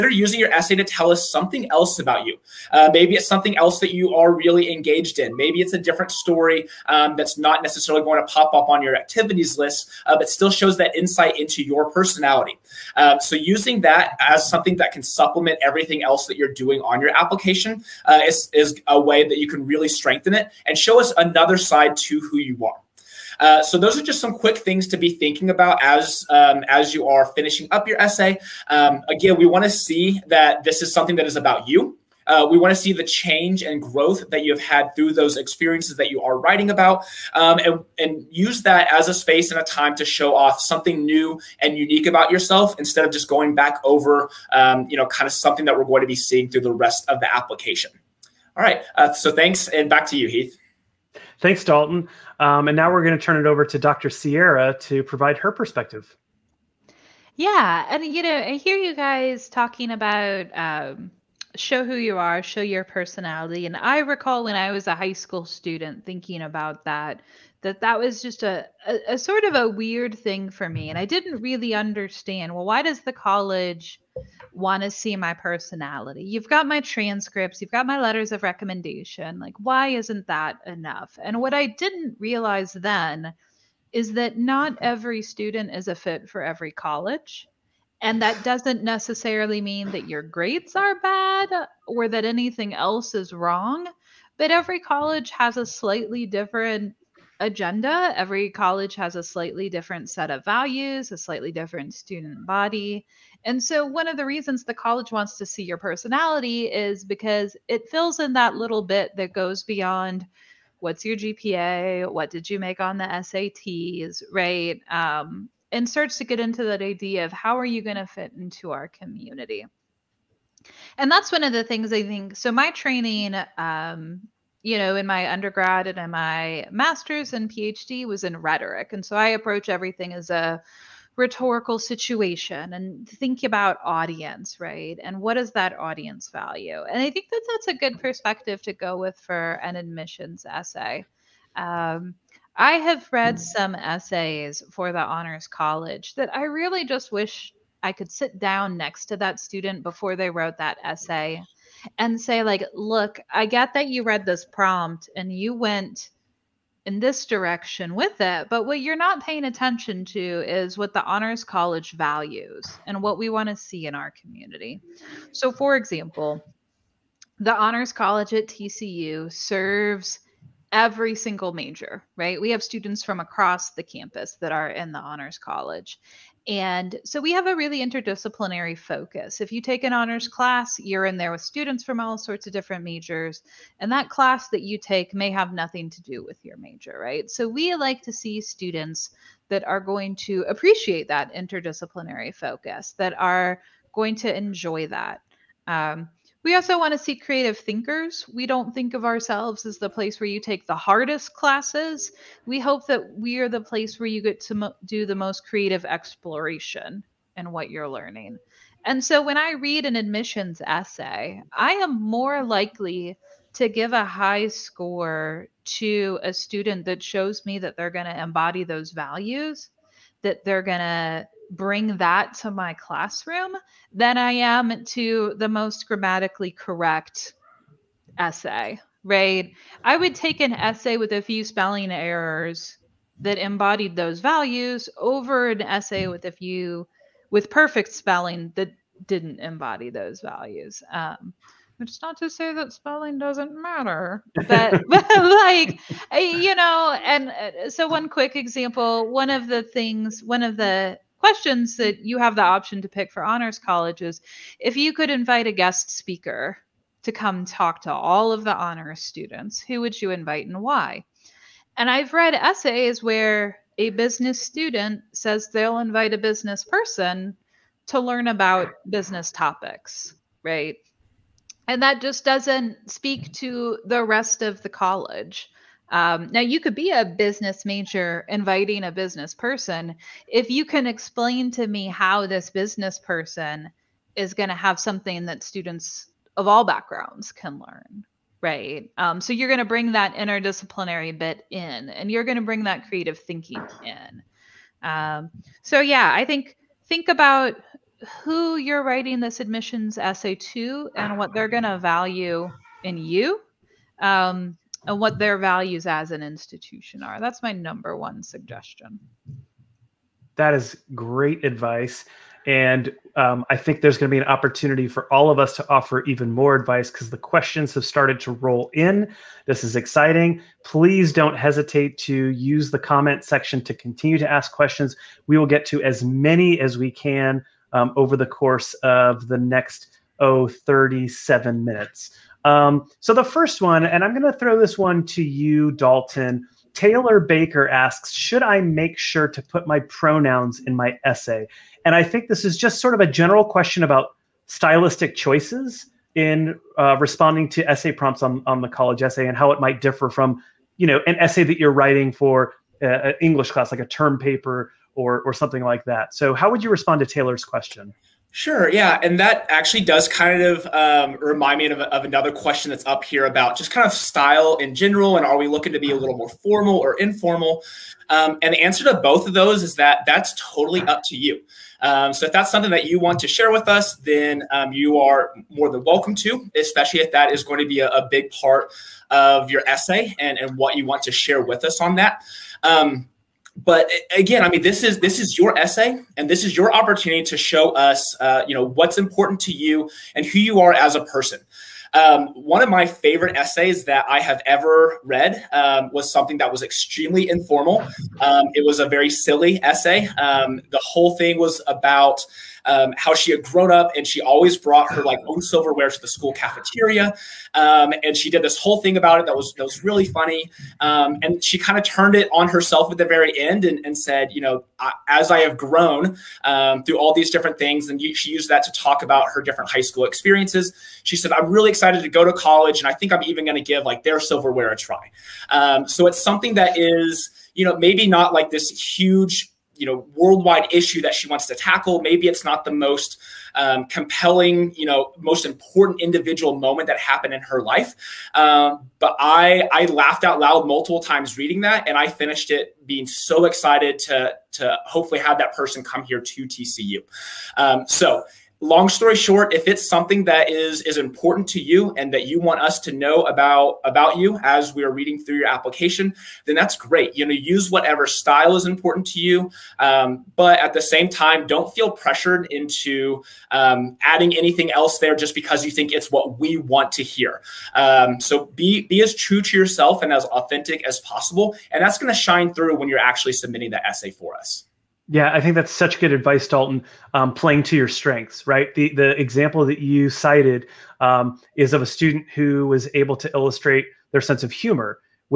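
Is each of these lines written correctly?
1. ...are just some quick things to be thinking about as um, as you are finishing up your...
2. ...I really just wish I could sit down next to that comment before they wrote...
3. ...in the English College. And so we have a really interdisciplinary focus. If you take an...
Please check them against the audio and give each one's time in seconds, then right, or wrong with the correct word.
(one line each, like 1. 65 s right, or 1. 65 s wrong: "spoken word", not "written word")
1. 23 s right
2. 146 s wrong: "student", not "comment"
3. 174 s wrong: "Honors", not "English".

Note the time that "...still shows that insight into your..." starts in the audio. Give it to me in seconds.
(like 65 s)
10 s.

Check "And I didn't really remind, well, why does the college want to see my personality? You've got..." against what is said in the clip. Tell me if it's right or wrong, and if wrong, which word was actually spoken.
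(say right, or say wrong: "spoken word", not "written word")
wrong: "understand", not "remind".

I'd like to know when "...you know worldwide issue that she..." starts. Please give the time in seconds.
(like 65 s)
429 s.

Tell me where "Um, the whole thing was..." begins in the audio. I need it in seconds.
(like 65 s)
400 s.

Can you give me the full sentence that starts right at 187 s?
So we like to see students that are going to appreciate that interdisciplinary focus, that are going to enjoy that.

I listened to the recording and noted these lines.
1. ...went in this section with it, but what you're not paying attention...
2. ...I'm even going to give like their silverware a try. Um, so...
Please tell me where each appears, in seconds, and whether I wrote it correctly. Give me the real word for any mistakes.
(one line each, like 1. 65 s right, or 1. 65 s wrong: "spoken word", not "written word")
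1. 155 s wrong: "direction", not "section"
2. 423 s right.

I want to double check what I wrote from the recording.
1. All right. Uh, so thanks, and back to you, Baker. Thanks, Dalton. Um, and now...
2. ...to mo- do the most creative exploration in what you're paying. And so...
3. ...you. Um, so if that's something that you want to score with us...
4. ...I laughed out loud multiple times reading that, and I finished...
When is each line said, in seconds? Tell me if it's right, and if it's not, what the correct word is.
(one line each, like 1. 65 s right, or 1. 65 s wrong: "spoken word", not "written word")
1. 48 s wrong: "Heath", not "Baker"
2. 204 s wrong: "learning", not "paying"
3. 371 s wrong: "share", not "score"
4. 439 s right.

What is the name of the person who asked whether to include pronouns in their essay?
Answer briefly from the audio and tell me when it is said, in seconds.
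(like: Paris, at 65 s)
Taylor Baker, at 336 s.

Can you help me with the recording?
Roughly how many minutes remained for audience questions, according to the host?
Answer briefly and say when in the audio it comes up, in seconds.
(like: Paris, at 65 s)
37, at 330 s.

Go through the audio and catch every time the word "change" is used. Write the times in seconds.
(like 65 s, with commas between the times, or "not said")
33 s.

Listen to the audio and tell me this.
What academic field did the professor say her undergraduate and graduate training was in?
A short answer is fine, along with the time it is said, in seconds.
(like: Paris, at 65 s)
Rhetoric, at 128 s.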